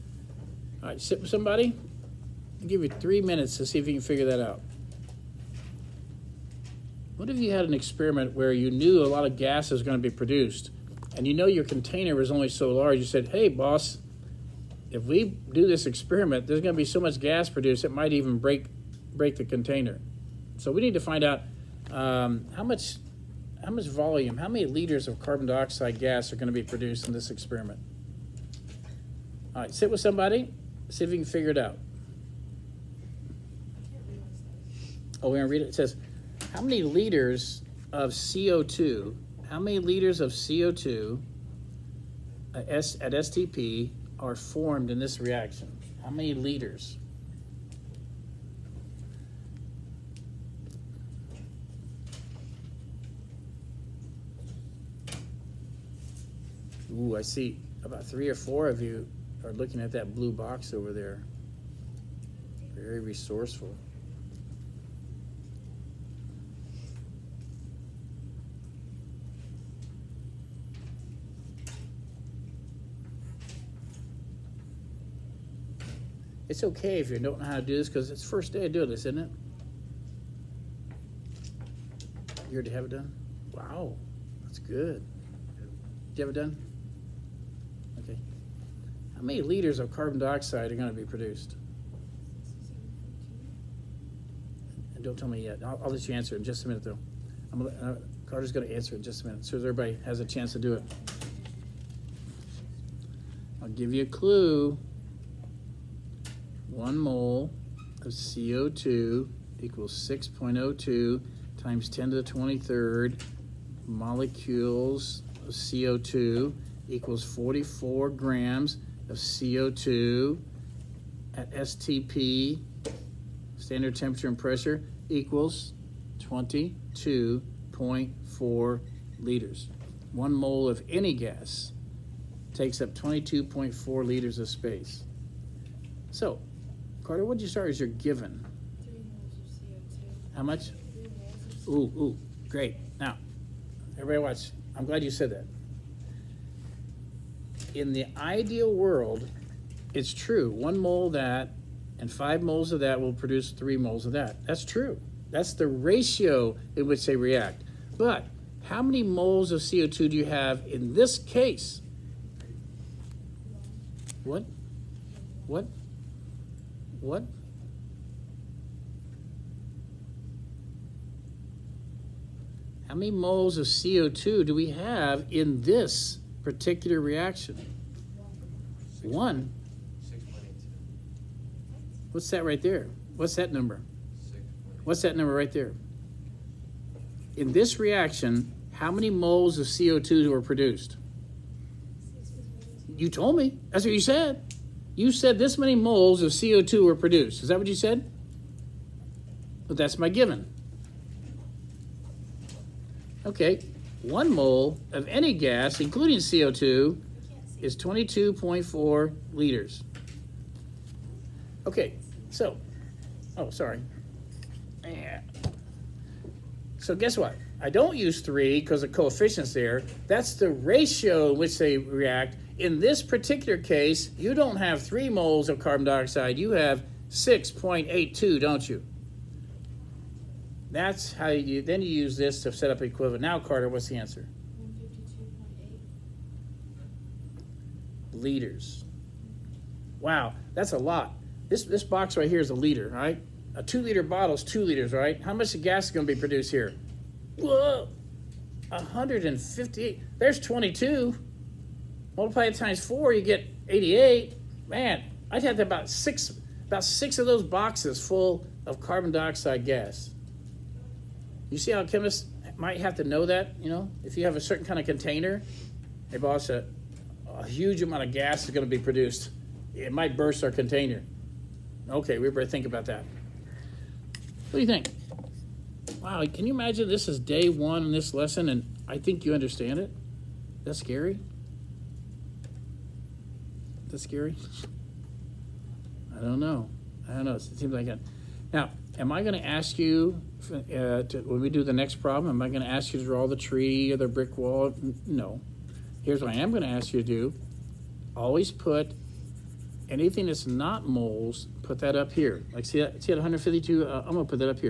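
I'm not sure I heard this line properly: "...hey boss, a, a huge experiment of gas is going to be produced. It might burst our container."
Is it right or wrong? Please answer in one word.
wrong.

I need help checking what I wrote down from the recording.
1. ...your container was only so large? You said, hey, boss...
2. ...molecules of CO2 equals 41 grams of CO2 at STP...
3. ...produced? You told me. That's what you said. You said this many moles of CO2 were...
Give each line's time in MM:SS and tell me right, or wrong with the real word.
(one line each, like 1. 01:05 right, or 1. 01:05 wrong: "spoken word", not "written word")
1. 00:11 right
2. 01:53 wrong: "44", not "41"
3. 03:10 right.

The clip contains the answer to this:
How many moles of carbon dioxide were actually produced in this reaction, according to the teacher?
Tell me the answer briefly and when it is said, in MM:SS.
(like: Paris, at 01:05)
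6.82, at 03:47.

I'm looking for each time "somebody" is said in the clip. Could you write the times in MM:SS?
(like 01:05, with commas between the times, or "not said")
00:01, 00:30.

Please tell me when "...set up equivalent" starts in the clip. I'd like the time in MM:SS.
03:52.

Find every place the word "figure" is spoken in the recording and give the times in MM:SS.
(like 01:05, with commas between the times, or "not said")
00:04, 00:31.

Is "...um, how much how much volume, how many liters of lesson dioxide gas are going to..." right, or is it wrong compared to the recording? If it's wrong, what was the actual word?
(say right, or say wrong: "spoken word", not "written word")
wrong: "carbon", not "lesson".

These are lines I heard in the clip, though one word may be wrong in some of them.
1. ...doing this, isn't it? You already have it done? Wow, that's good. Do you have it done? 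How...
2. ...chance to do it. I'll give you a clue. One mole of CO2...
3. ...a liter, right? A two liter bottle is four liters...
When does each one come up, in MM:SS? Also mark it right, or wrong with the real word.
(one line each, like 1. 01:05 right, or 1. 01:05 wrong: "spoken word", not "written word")
1. 01:18 right
2. 01:40 right
3. 04:02 wrong: "two", not "four".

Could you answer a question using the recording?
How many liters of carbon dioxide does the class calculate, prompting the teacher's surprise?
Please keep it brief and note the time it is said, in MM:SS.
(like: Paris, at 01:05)
158, at 04:08.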